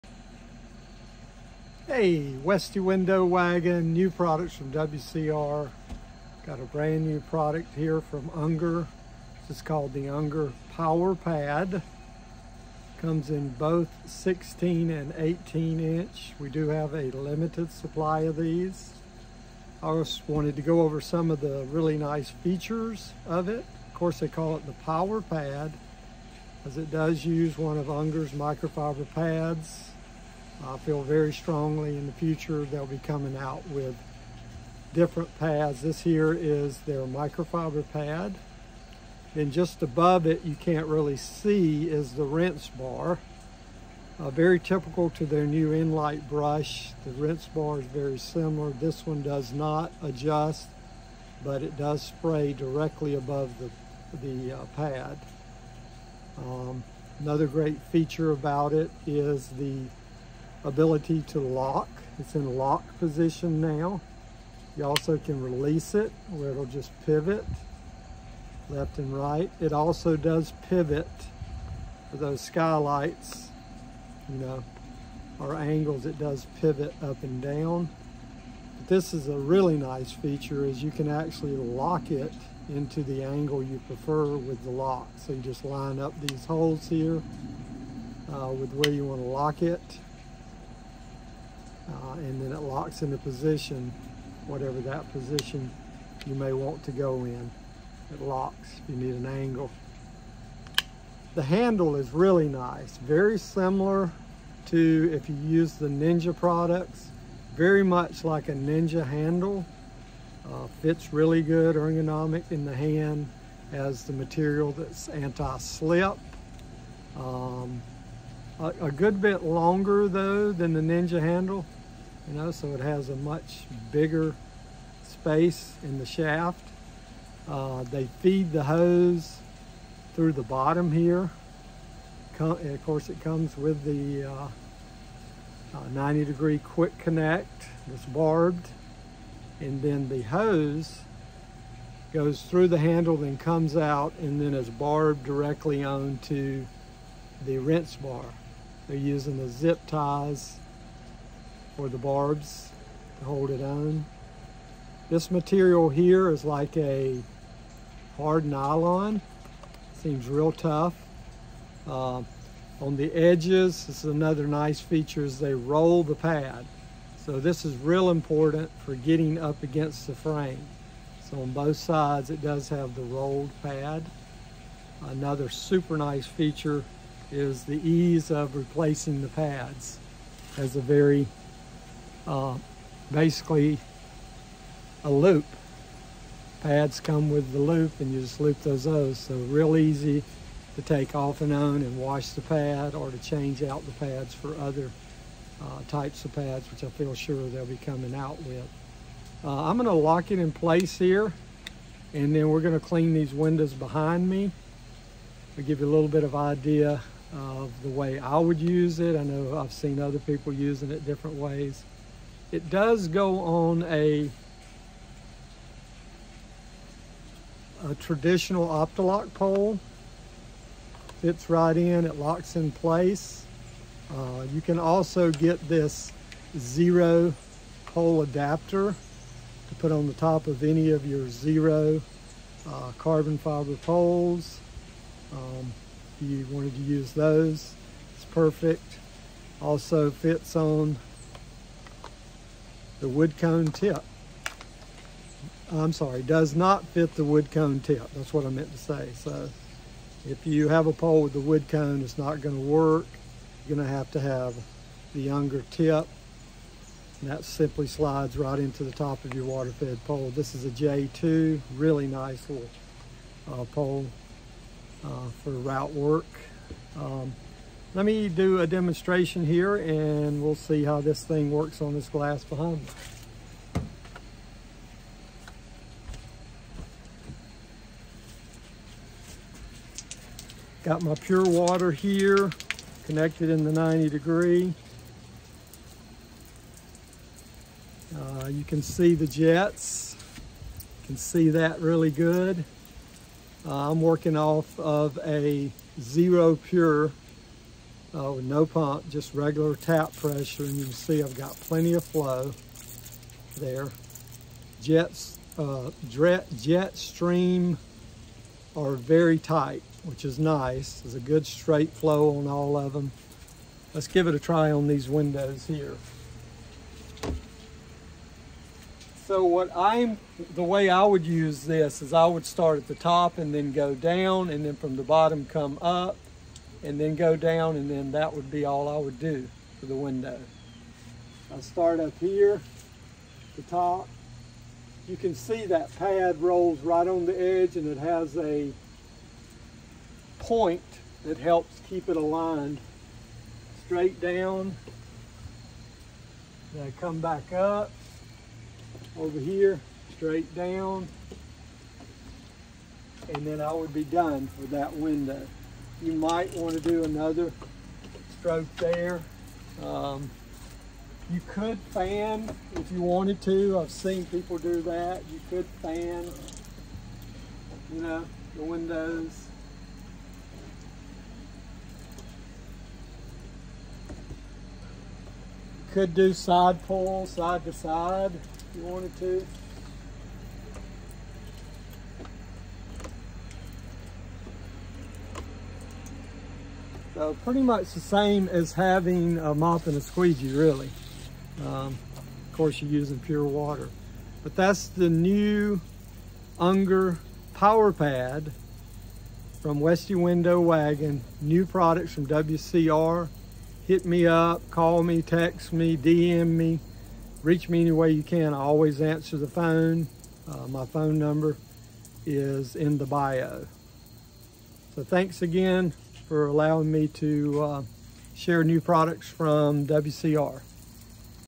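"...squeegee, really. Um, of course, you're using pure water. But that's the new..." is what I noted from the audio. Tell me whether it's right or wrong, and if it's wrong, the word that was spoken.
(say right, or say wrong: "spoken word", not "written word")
right.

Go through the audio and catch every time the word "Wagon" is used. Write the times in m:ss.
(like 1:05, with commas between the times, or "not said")
0:03, 6:40.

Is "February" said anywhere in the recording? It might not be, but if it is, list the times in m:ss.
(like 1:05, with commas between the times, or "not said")
not said.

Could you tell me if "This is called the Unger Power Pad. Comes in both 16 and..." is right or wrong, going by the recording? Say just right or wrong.
right.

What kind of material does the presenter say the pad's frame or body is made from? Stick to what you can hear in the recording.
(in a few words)
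Hard nylon.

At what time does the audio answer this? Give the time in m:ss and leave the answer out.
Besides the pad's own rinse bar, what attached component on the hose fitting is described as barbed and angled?
2:15.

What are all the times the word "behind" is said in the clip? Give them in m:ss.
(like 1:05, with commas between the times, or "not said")
3:23, 4:32.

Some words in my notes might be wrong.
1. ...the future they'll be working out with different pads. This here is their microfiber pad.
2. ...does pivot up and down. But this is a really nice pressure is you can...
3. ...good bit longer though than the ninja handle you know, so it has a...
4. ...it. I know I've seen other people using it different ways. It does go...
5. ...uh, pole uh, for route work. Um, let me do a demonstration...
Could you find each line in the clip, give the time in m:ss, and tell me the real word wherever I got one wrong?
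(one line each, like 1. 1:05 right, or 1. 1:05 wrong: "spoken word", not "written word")
1. 0:32 wrong: "coming", not "working"
2. 1:16 wrong: "feature", not "pressure"
3. 1:58 right
4. 3:28 right
5. 4:23 right.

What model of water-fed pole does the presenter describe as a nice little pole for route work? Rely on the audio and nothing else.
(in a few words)
J2.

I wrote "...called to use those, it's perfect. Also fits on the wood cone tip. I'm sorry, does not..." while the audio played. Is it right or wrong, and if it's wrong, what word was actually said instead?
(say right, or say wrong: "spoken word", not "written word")
wrong: "wanted", not "called".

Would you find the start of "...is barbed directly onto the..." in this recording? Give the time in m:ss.
2:24.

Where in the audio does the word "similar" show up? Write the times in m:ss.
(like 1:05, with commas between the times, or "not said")
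0:48, 1:43.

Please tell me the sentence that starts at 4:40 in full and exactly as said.
Got my pure water here, connected in the 90 degree.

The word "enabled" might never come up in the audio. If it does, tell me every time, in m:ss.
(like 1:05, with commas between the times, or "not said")
not said.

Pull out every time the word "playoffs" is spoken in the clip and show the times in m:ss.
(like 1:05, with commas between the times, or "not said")
not said.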